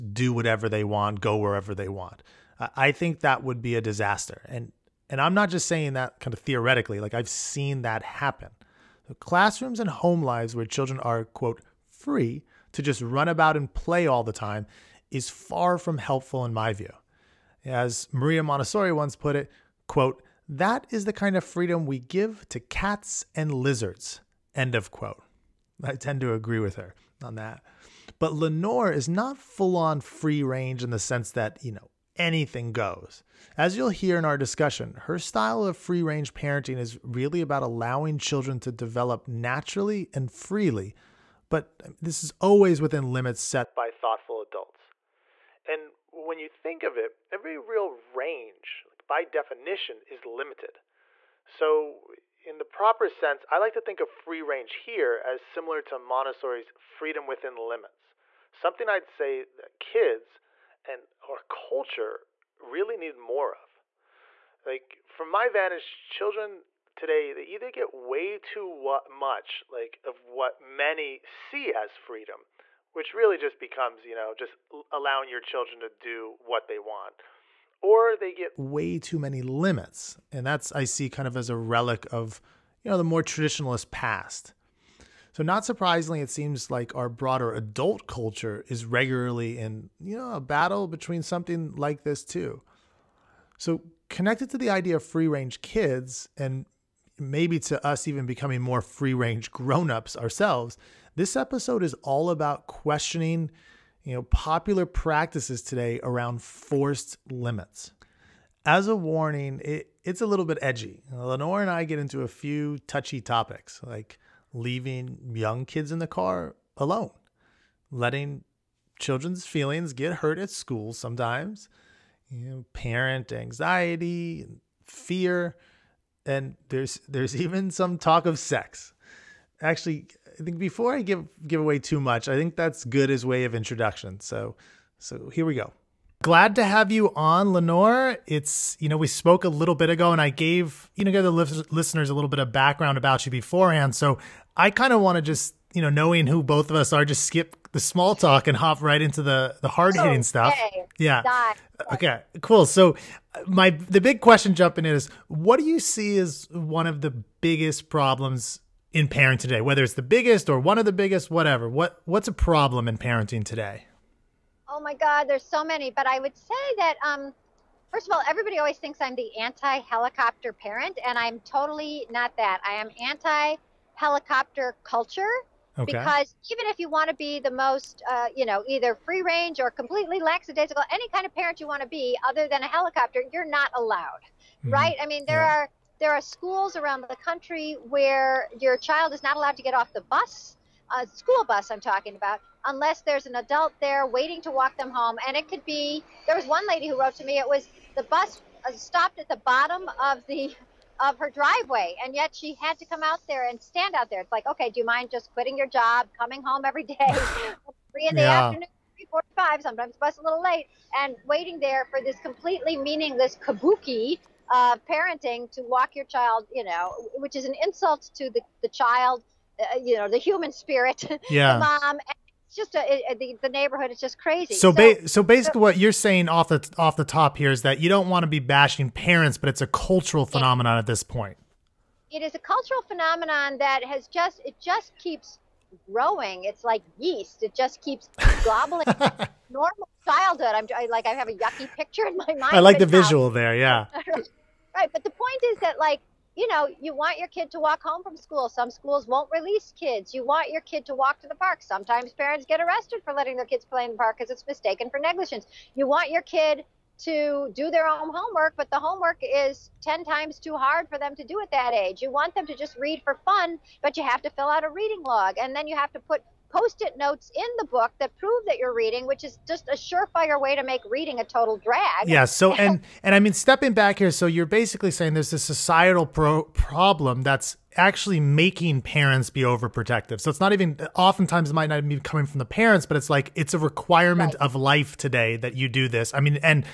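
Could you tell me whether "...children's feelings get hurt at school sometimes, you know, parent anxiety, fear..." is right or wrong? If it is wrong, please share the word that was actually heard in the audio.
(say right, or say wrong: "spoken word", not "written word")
right.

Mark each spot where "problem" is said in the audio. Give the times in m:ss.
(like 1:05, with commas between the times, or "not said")
2:37, 2:42, 4:36.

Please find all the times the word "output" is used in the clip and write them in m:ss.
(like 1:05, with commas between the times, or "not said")
not said.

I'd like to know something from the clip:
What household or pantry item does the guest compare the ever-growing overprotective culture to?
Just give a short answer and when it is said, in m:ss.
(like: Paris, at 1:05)
Yeast, at 3:56.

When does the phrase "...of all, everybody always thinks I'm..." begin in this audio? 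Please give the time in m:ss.
2:48.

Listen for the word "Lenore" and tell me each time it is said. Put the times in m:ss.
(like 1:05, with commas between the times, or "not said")
0:28, 1:51, 2:17.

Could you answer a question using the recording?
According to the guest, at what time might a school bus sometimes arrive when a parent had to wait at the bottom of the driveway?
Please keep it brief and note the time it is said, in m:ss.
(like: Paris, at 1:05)
3:45, at 3:28.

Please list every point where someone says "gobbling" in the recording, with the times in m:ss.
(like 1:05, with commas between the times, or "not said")
3:58.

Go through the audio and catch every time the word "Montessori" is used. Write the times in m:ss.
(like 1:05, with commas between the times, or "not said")
0:18, 0:55.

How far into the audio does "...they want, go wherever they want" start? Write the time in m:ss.
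0:00.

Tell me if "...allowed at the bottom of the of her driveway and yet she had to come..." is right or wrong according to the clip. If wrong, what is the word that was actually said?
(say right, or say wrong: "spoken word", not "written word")
wrong: "stopped", not "allowed".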